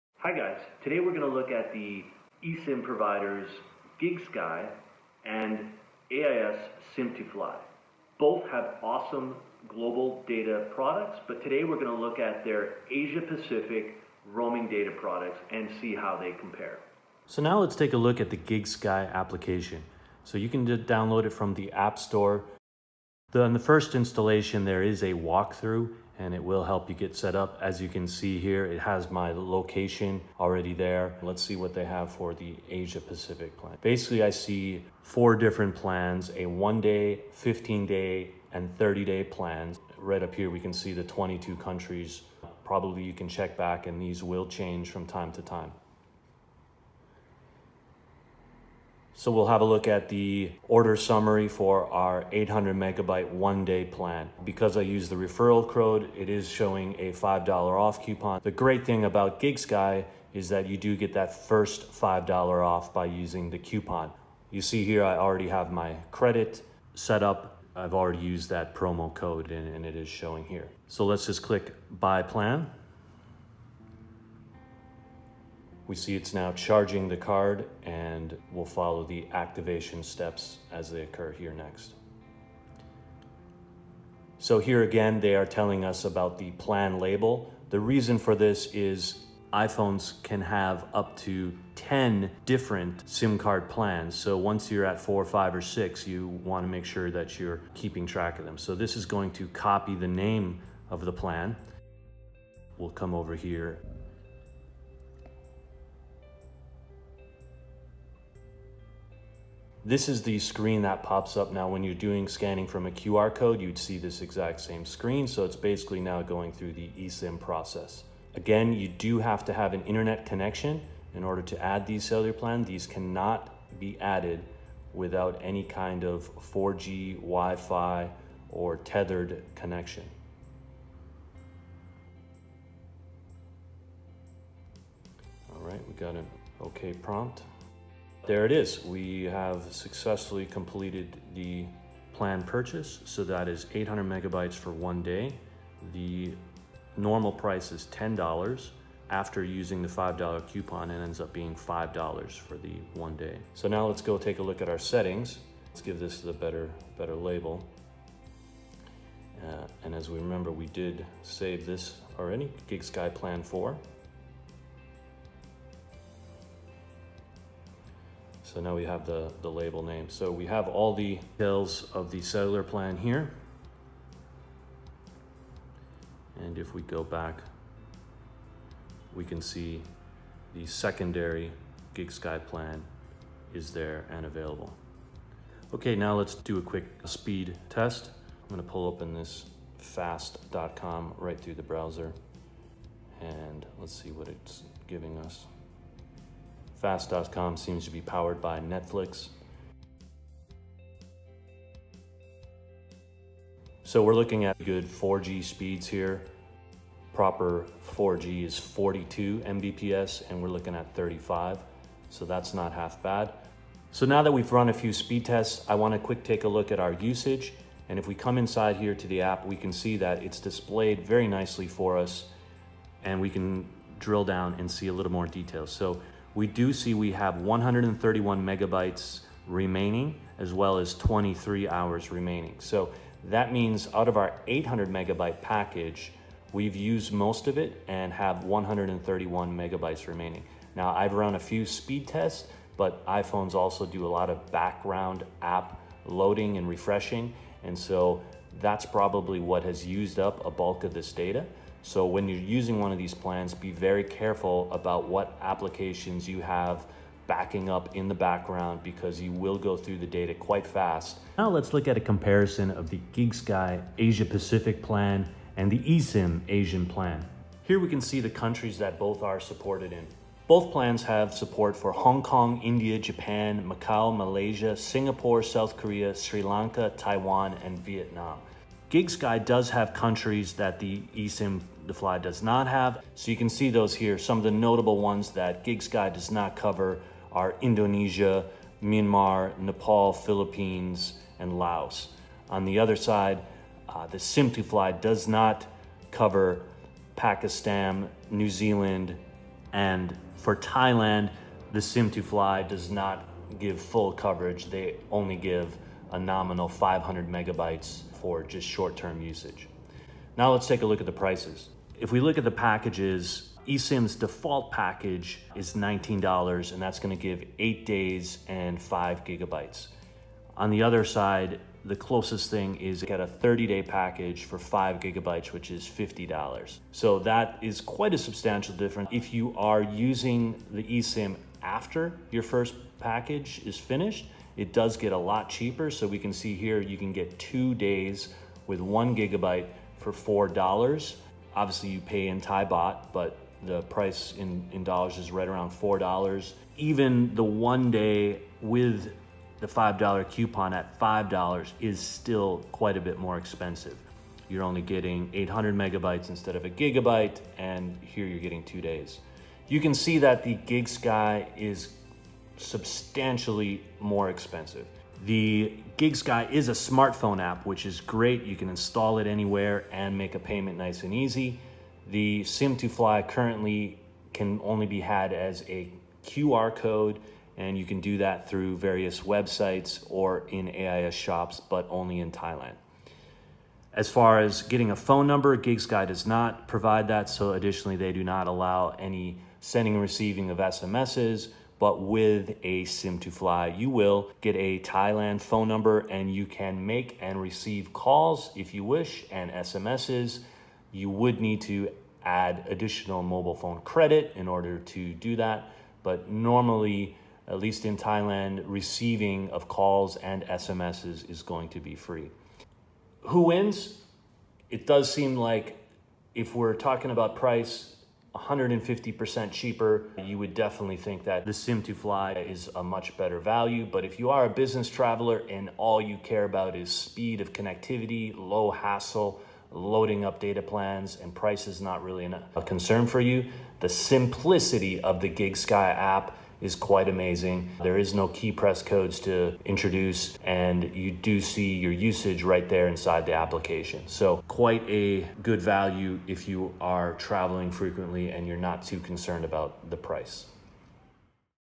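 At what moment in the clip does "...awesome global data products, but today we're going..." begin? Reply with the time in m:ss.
0:08.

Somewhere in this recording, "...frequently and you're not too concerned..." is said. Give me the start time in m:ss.
7:27.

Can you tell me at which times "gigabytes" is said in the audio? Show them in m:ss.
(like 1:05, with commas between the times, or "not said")
5:19, 5:24, 5:39, 5:56.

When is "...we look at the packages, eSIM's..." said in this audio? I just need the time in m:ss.
5:12.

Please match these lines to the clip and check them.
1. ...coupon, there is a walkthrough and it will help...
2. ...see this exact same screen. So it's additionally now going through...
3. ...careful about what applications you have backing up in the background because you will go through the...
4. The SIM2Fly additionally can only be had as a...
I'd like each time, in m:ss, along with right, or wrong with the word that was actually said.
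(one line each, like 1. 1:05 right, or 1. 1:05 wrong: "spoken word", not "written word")
1. 0:23 wrong: "installation", not "coupon"
2. 1:53 wrong: "basically", not "additionally"
3. 4:14 right
4. 6:12 wrong: "currently", not "additionally".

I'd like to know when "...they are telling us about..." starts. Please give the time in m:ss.
1:25.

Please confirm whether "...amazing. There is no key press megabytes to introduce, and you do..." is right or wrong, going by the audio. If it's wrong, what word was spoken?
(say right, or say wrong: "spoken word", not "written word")
wrong: "codes", not "megabytes".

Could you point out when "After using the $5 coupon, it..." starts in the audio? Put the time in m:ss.
2:29.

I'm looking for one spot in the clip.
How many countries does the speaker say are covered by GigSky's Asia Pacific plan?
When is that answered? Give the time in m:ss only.
0:41.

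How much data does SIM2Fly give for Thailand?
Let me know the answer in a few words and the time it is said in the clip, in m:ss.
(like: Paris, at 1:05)
500 megabytes, at 5:06.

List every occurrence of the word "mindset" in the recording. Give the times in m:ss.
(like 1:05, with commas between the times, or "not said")
not said.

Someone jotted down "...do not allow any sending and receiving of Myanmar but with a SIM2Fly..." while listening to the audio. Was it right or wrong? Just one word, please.
wrong.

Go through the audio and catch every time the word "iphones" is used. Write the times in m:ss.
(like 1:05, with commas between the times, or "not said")
1:29, 4:03.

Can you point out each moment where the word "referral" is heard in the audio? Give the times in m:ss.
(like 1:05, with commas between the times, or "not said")
0:55.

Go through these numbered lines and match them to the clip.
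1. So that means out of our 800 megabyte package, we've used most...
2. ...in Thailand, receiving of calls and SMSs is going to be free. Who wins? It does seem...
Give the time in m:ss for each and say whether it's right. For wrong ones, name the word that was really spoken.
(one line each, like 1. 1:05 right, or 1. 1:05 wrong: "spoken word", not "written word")
1. 3:52 right
2. 6:47 right.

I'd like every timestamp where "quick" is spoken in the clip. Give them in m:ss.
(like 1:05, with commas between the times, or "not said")
3:06, 3:35.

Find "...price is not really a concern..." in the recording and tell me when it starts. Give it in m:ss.
7:11.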